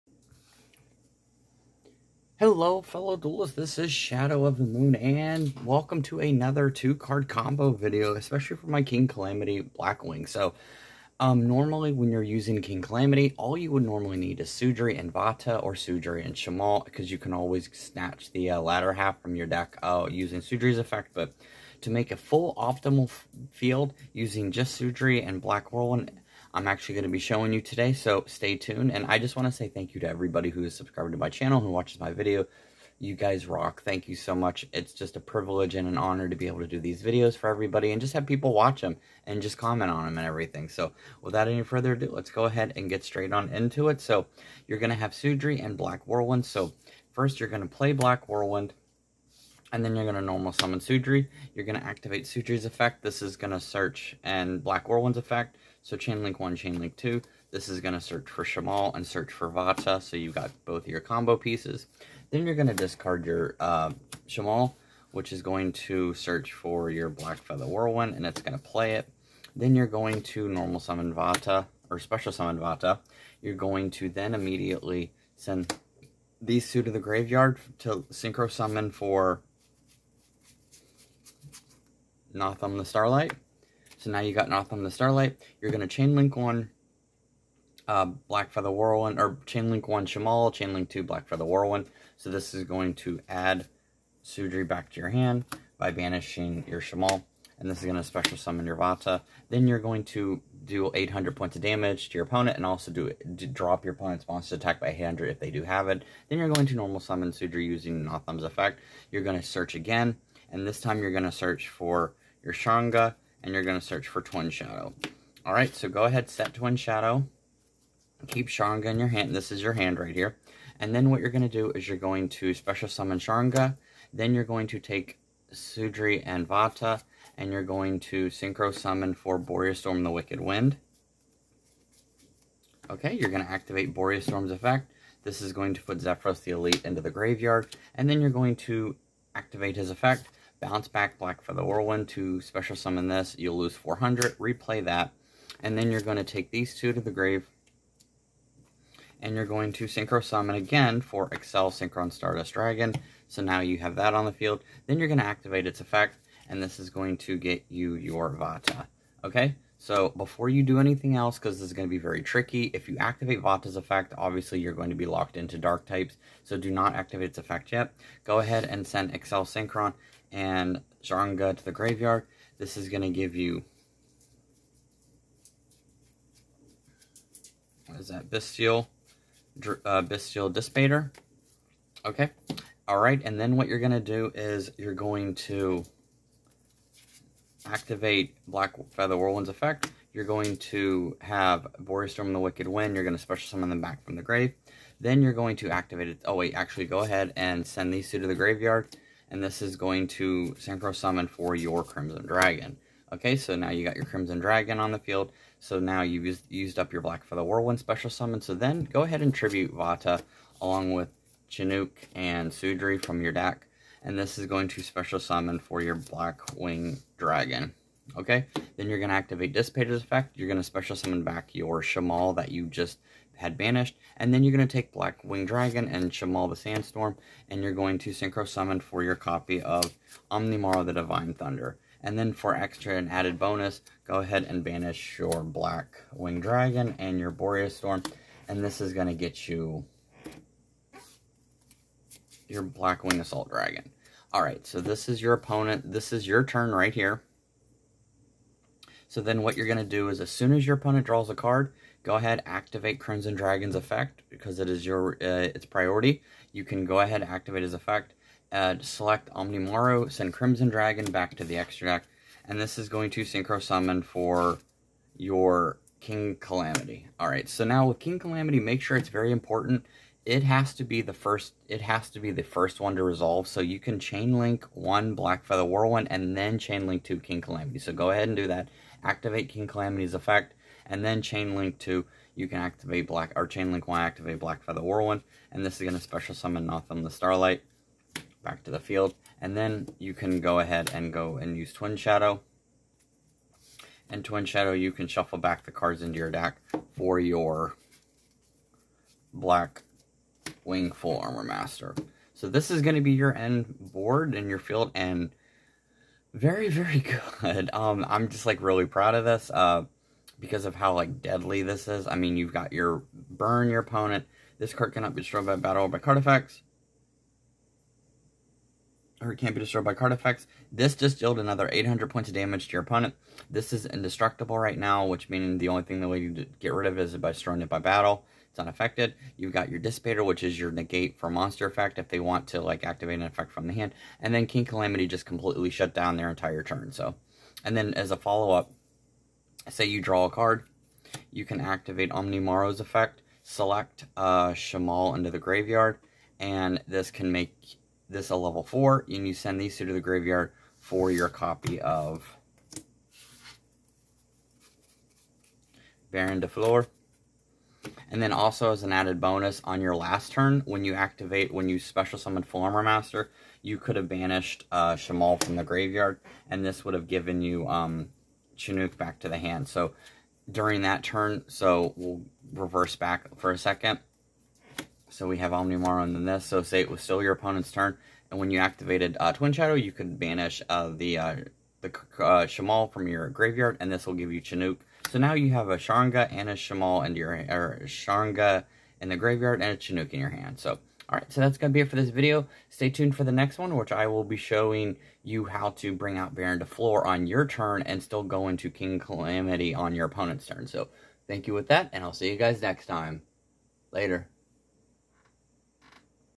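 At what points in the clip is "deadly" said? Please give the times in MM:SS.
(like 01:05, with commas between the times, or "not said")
05:11.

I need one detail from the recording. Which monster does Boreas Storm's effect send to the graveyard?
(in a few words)
Zephyros the Elite.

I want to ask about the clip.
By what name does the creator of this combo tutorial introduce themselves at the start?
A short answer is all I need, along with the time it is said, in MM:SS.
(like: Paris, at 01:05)
Shadow of the Moon, at 00:03.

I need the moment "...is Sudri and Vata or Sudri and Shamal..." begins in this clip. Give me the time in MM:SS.
00:14.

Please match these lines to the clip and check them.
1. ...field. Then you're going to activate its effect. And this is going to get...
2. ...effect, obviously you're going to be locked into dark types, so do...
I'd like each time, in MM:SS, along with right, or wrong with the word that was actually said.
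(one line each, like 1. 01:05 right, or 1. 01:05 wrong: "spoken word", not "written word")
1. 02:34 right
2. 02:43 right.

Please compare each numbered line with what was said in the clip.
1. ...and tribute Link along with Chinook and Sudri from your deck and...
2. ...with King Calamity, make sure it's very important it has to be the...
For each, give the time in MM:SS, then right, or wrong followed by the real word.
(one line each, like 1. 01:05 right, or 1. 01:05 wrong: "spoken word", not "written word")
1. 03:29 wrong: "Vata", not "Link"
2. 04:27 right.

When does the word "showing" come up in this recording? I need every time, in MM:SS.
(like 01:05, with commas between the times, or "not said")
00:27, 06:34.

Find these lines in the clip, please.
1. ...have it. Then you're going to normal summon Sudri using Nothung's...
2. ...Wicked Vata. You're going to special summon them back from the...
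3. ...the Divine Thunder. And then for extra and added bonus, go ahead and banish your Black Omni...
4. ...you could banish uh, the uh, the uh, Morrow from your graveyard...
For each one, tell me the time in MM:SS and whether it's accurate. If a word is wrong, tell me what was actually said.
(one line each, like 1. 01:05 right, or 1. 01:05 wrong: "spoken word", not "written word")
1. 01:45 right
2. 03:12 wrong: "Wind", not "Vata"
3. 03:50 wrong: "Wing", not "Omni"
4. 06:19 wrong: "Shamal", not "Morrow".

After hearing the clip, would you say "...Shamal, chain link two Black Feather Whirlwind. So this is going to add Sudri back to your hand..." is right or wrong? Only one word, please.
right.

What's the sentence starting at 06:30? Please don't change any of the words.
So Alright, so that's going to be it for this video.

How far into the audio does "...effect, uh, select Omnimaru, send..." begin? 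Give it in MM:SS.
04:17.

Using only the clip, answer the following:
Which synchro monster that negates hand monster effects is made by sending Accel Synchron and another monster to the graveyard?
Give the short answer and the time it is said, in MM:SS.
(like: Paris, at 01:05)
Bestial Dissipator, at 03:00.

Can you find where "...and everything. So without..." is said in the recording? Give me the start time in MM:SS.
00:40.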